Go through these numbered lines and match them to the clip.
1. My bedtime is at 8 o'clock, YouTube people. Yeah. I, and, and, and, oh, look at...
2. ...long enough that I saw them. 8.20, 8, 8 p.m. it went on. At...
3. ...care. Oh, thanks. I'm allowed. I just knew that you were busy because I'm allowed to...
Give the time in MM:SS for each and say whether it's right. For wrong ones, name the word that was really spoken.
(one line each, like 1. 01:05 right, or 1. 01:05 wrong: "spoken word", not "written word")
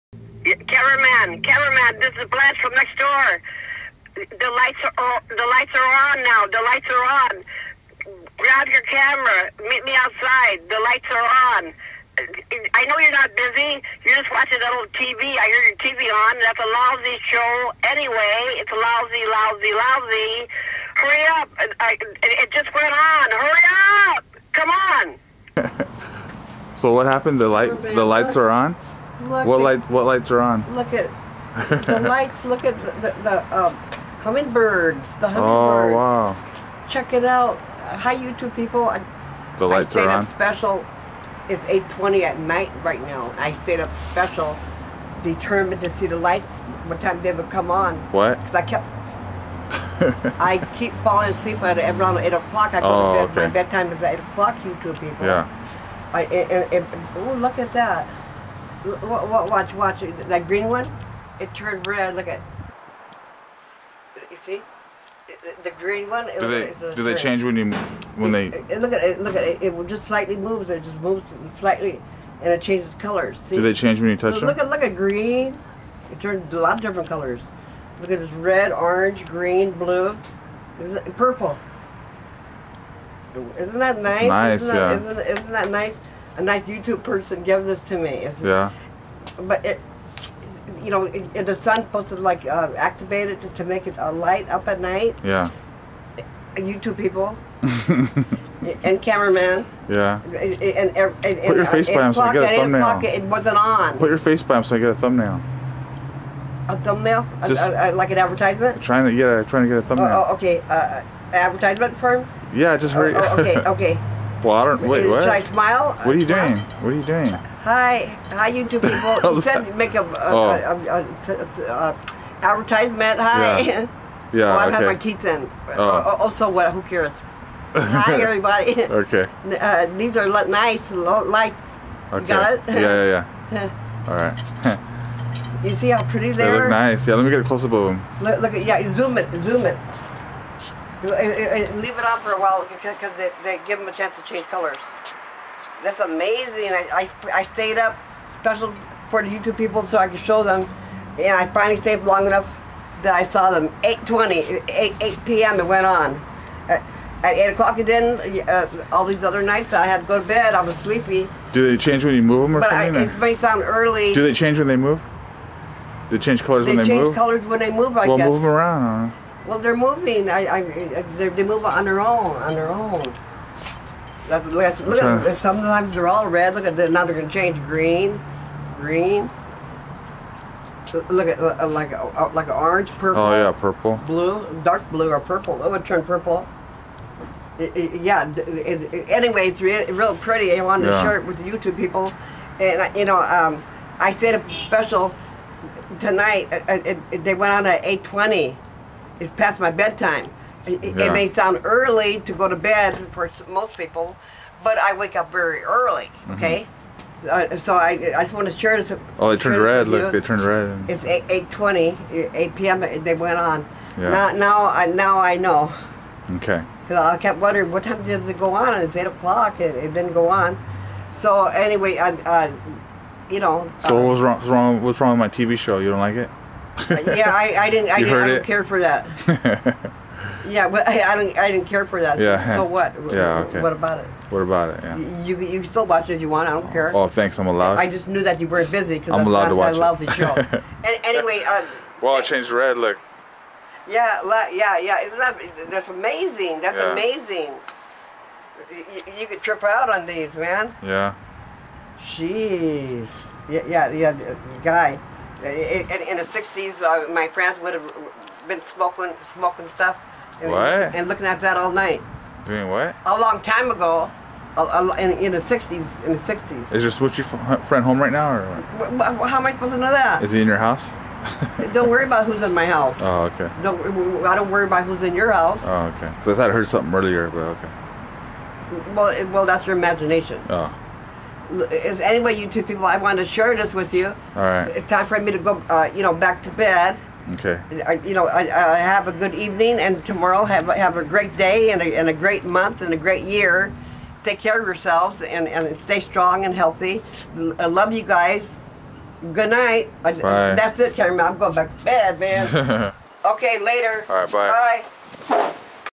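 1. 00:53 right
2. 02:32 right
3. 03:56 right.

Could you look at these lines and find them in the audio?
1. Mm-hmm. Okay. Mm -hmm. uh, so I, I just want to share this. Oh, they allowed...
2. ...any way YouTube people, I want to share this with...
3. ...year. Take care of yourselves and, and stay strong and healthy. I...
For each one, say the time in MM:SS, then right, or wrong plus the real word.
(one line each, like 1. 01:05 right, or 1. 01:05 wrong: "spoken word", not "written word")
1. 03:26 wrong: "turned", not "allowed"
2. 04:41 right
3. 04:53 right.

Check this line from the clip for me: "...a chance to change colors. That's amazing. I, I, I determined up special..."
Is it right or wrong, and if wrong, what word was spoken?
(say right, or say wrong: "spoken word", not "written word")
wrong: "stayed", not "determined".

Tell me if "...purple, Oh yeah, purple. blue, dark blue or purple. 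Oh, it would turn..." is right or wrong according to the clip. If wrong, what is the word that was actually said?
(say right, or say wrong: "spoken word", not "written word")
right.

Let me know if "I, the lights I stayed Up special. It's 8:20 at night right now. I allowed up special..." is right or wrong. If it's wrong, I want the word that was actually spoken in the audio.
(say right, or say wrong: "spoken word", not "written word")
wrong: "stayed", not "allowed".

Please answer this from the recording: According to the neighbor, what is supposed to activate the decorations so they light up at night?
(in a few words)
The sun.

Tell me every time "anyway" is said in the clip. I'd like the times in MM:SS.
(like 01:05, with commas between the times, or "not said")
00:17, 03:09, 03:41, 04:01.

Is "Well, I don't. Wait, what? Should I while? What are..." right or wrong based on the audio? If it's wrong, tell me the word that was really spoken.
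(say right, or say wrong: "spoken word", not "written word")
wrong: "smile", not "while".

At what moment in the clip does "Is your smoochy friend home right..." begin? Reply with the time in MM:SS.
04:26.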